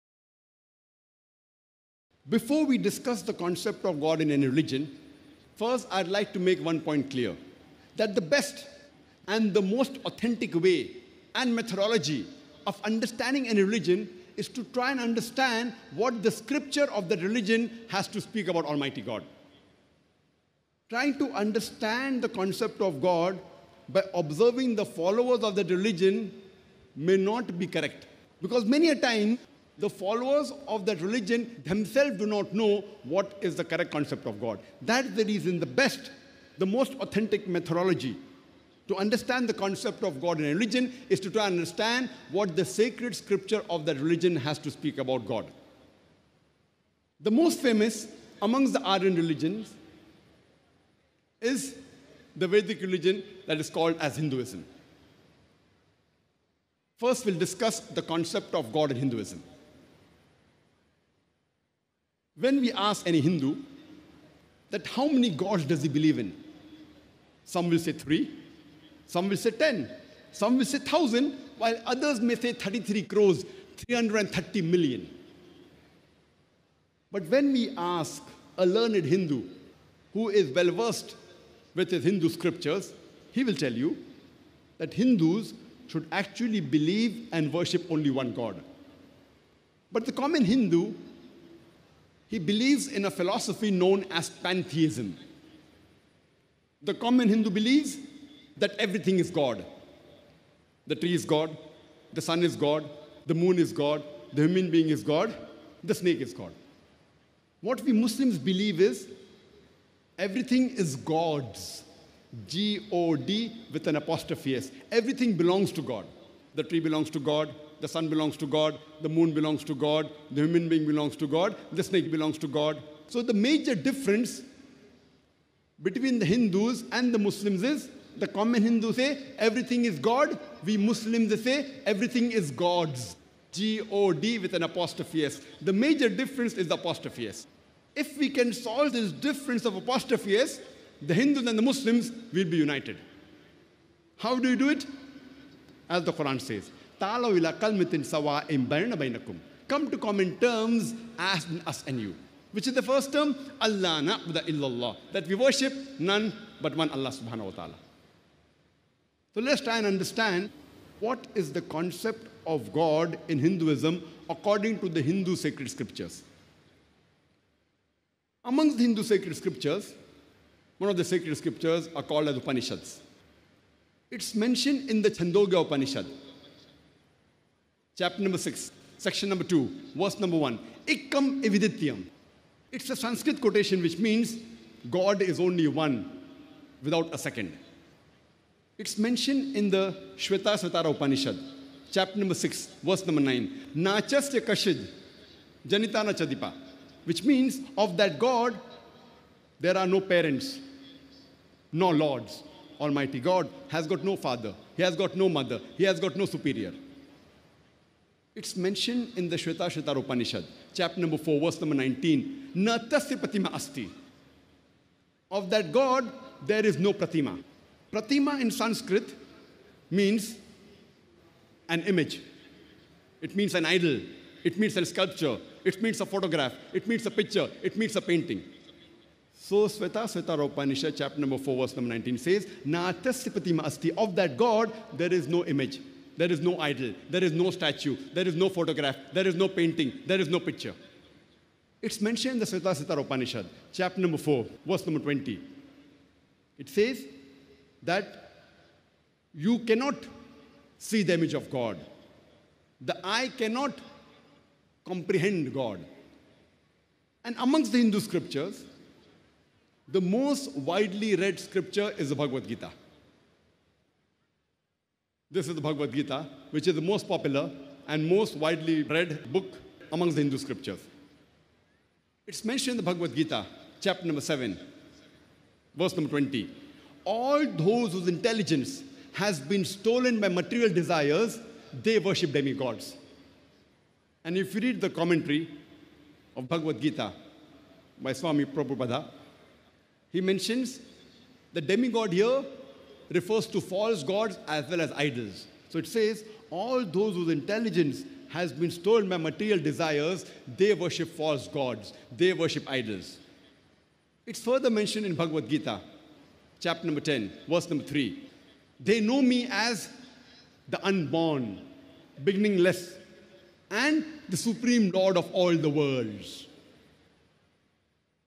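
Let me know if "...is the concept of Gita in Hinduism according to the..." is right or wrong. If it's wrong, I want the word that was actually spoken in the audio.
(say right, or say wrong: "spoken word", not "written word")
wrong: "God", not "Gita".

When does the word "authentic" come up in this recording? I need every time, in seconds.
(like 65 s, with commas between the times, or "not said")
10 s, 36 s.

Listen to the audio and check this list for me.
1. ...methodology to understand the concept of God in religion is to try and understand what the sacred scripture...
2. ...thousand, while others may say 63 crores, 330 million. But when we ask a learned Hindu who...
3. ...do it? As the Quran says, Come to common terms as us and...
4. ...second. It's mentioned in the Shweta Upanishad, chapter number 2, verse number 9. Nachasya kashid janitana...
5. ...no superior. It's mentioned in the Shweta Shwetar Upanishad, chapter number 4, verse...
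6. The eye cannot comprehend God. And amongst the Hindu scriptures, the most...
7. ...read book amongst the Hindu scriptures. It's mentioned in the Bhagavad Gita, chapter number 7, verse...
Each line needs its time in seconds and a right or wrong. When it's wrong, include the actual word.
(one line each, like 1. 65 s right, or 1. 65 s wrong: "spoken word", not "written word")
1. 37 s right
2. 70 s wrong: "33", not "63"
3. 144 s right
4. 187 s wrong: "6", not "2"
5. 206 s right
6. 252 s right
7. 268 s right.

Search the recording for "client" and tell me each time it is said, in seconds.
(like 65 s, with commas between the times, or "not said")
not said.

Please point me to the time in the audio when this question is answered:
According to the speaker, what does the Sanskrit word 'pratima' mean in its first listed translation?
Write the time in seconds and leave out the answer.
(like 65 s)
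221 s.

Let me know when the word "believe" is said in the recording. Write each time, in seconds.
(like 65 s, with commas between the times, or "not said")
65 s, 86 s, 92 s, 97 s, 108 s.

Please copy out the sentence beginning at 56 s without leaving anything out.
First, we'll discuss the concept of God in Hinduism.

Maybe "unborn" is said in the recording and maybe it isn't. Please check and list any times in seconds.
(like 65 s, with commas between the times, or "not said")
310 s.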